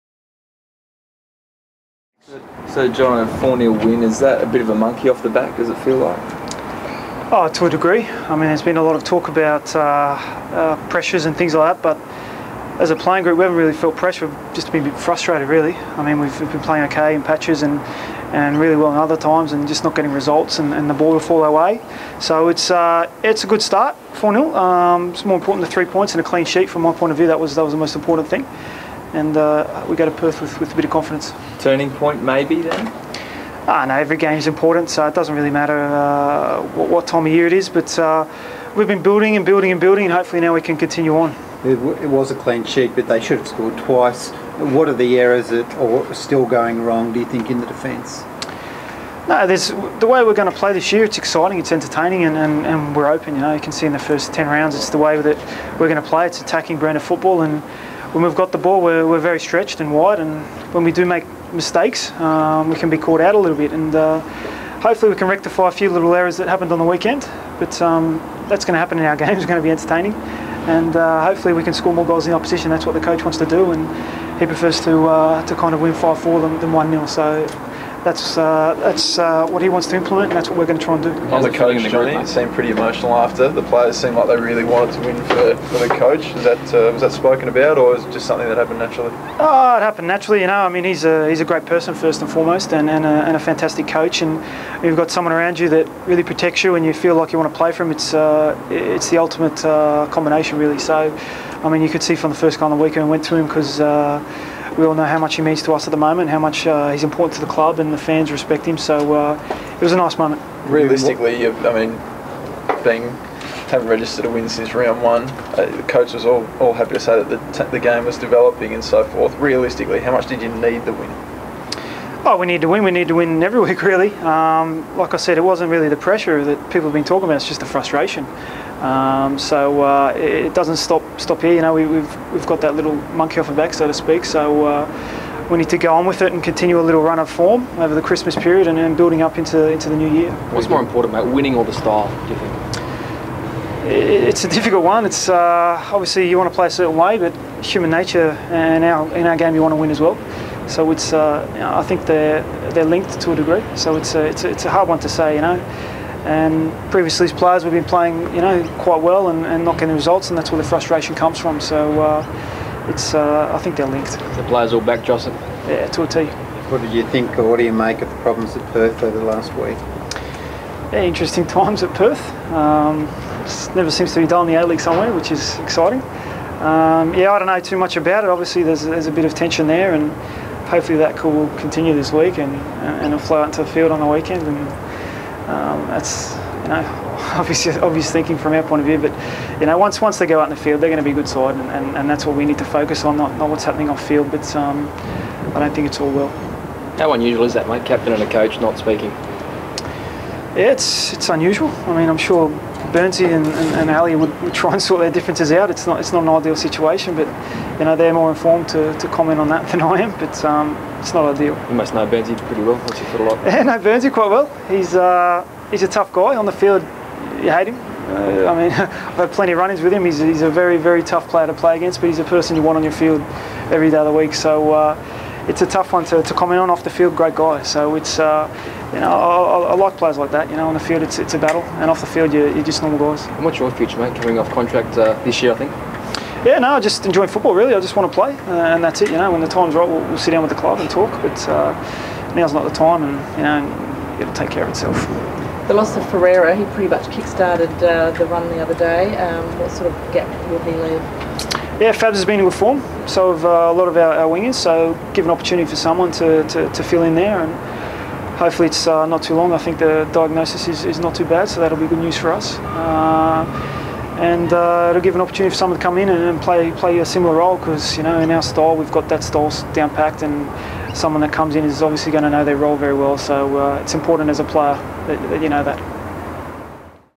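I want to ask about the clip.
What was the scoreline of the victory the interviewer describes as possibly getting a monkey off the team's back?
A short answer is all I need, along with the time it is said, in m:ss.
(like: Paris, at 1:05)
4-0, at 0:03.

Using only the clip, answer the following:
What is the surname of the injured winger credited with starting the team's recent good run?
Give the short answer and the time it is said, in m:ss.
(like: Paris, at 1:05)
Ferreira, at 4:06.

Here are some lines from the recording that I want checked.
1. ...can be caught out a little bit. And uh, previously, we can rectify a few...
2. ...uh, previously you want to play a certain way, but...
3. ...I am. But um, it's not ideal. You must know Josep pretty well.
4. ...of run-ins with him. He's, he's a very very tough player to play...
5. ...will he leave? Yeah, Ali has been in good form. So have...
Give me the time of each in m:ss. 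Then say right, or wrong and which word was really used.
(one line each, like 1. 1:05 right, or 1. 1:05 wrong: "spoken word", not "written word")
1. 1:02 wrong: "hopefully", not "previously"
2. 2:25 wrong: "obviously", not "previously"
3. 3:29 wrong: "Burnsy", not "Josep"
4. 3:39 right
5. 4:10 wrong: "Fabs", not "Ali".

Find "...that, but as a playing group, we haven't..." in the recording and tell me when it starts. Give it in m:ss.
0:11.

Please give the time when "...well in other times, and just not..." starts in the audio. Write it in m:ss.
0:18.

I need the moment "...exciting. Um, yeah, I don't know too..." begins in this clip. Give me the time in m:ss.
2:55.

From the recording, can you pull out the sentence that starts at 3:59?
You know, when the time's right, we'll, we'll sit down with the club and talk.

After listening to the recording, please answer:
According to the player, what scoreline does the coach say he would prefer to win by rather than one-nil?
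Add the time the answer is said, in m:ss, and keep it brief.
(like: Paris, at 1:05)
5-4, at 1:15.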